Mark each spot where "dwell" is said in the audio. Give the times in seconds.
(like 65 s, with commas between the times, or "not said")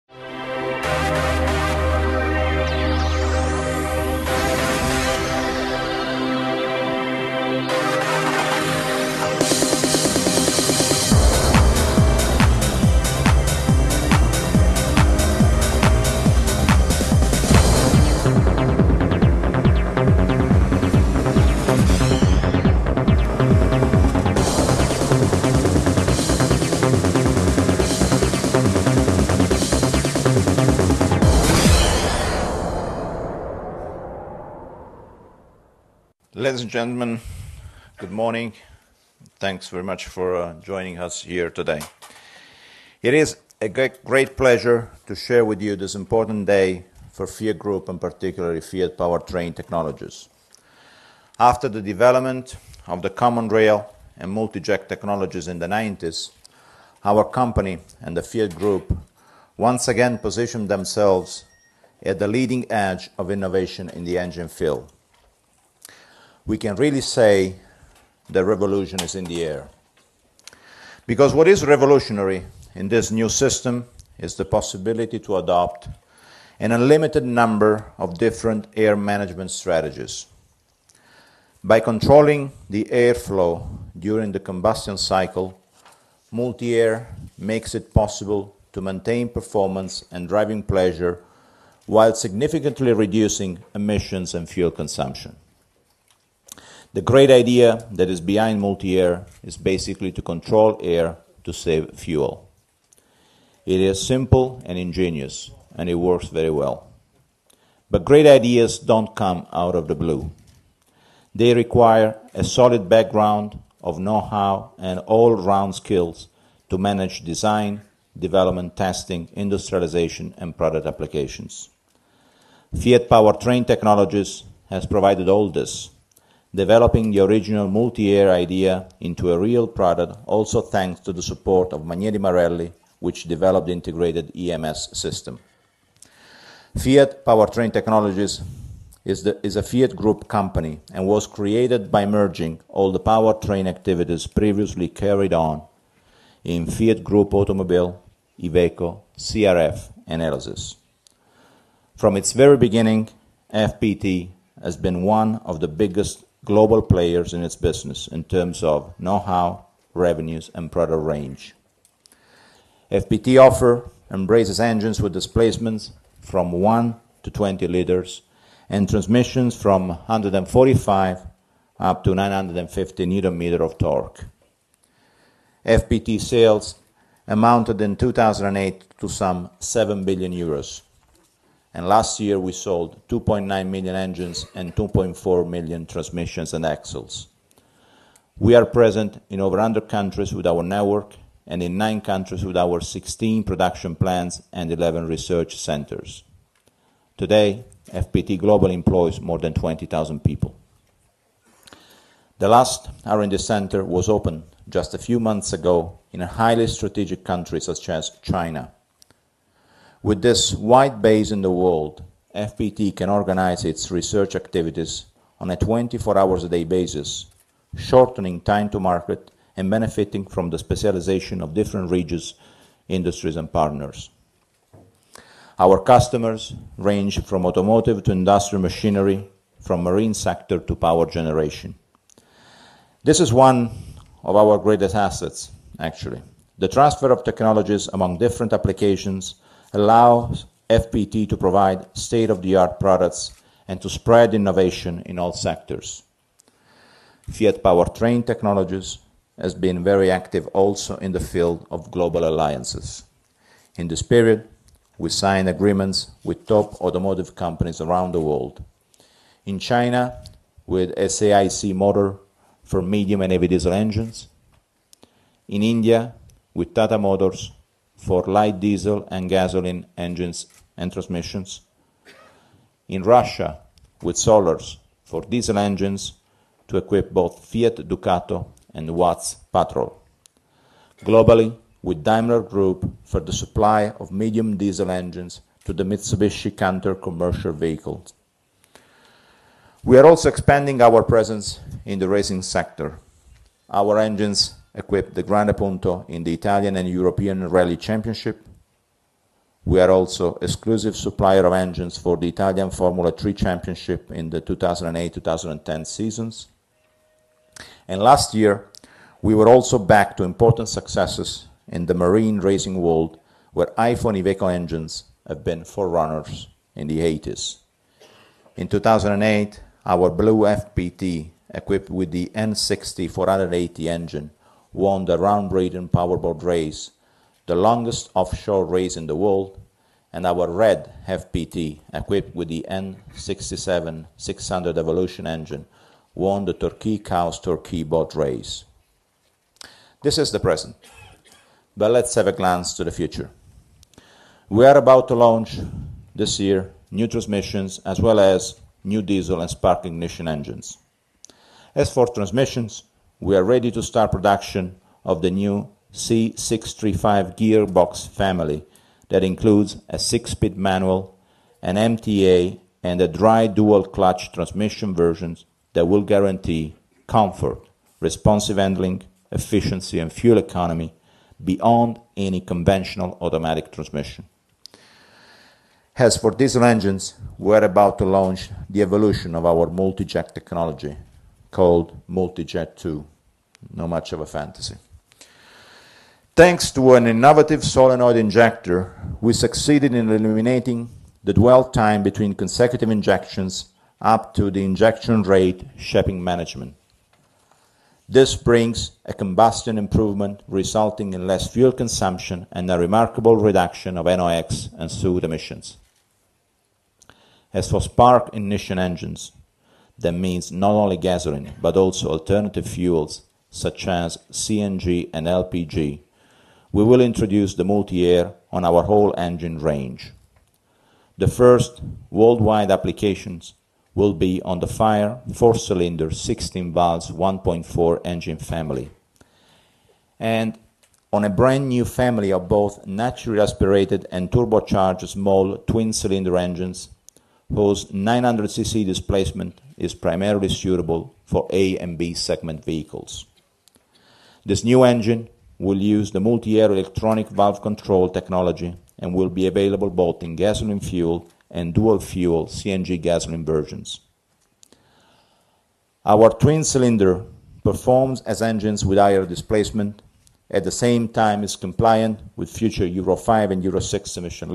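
391 s.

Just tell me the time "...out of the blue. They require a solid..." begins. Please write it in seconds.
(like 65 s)
109 s.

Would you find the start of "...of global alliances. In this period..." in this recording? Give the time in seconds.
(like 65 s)
251 s.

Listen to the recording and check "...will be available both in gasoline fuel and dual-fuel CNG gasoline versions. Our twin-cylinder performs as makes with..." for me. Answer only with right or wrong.
wrong.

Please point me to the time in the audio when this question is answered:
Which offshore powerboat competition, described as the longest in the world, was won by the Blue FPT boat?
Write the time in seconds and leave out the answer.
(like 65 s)
325 s.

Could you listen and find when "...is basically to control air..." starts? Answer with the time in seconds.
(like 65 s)
99 s.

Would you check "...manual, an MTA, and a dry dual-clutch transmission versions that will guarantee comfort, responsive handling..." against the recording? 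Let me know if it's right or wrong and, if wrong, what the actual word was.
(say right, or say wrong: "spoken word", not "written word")
right.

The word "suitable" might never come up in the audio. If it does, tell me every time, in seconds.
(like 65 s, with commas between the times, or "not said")
440 s.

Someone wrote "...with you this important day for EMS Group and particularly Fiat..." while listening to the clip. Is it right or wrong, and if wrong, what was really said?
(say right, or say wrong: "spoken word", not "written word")
wrong: "Fiat", not "EMS".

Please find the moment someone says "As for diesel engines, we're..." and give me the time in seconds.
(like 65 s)
375 s.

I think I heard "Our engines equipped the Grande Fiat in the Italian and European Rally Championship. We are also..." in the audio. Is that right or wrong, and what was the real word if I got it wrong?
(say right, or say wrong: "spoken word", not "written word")
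wrong: "Punto", not "Fiat".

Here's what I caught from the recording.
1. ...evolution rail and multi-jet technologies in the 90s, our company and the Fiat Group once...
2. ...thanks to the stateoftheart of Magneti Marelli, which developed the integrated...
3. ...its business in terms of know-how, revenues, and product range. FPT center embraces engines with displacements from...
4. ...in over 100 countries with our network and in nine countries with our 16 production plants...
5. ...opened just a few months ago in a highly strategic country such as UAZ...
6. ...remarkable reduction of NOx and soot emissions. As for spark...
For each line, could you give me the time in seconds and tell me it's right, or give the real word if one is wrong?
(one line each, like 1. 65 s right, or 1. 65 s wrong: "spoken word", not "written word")
1. 53 s wrong: "common", not "evolution"
2. 130 s wrong: "support", not "stateoftheart"
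3. 157 s wrong: "offer", not "center"
4. 189 s right
5. 204 s wrong: "China", not "UAZ"
6. 402 s right.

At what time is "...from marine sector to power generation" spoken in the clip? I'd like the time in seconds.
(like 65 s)
229 s.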